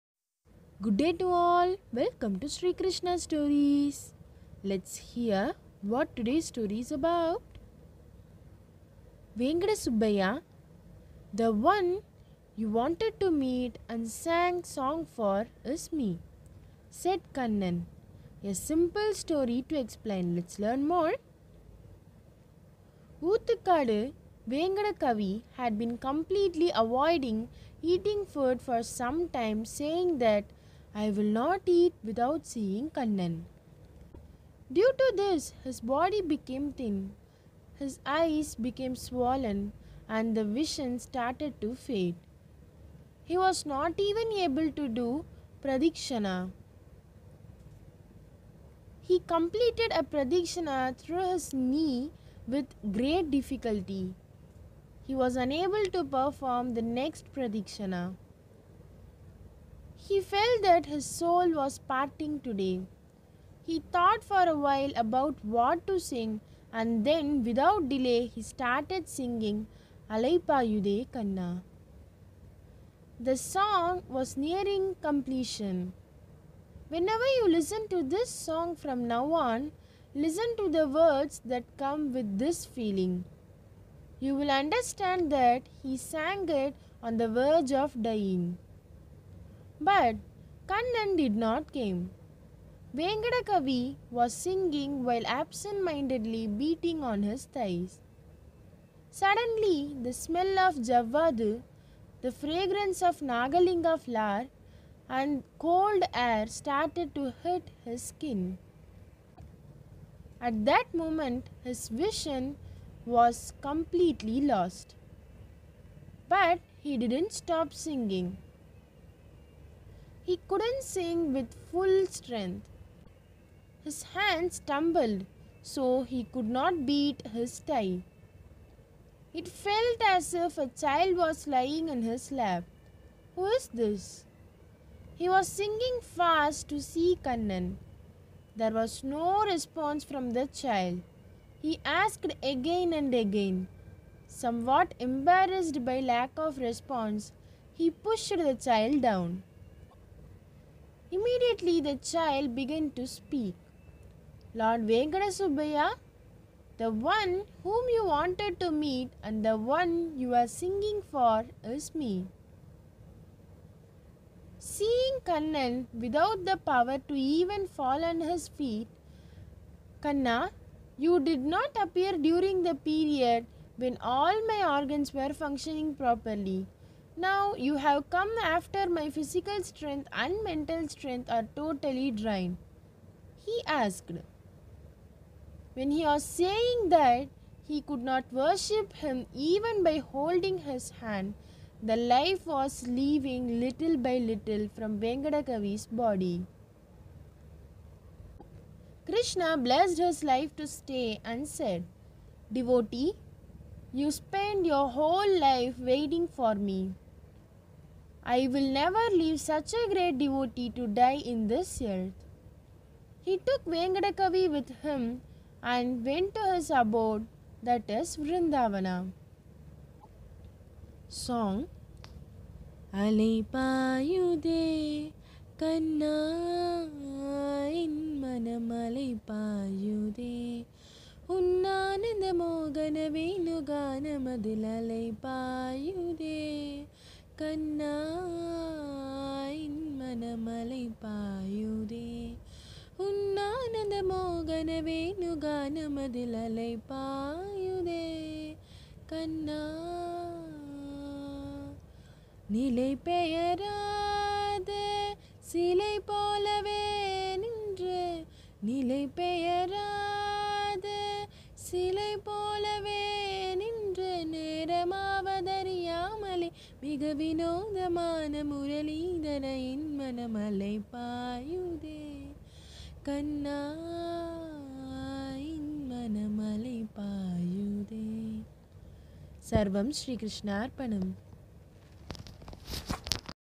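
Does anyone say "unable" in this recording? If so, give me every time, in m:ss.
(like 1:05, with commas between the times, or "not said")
0:55.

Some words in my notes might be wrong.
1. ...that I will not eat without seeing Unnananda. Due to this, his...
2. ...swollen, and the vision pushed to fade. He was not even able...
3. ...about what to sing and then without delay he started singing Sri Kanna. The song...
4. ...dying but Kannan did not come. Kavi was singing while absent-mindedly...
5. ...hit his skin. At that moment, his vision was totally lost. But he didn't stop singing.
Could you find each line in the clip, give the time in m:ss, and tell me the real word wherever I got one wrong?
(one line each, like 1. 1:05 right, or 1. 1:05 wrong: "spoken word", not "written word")
1. 0:30 wrong: "Kannan", not "Unnananda"
2. 0:38 wrong: "started", not "pushed"
3. 1:04 wrong: "Alaipayuthe", not "Sri"
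4. 1:28 right
5. 1:47 wrong: "completely", not "totally".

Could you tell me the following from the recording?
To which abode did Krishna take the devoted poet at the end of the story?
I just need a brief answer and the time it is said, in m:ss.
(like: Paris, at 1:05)
Vrindavana, at 3:38.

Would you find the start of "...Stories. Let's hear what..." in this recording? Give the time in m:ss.
0:03.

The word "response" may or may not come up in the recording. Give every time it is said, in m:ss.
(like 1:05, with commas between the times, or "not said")
2:19, 2:26.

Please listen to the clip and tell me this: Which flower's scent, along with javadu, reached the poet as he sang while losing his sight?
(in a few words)
Nagalinga flower.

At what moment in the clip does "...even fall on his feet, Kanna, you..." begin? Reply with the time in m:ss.
2:47.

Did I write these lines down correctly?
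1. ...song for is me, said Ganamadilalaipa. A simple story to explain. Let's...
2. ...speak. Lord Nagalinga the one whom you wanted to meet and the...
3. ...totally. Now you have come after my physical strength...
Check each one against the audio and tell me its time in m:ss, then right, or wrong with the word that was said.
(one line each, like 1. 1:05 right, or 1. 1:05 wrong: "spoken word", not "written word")
1. 0:14 wrong: "Kannan", not "Ganamadilalaipa"
2. 2:33 wrong: "Venkata", not "Nagalinga"
3. 2:55 wrong: "properly", not "totally".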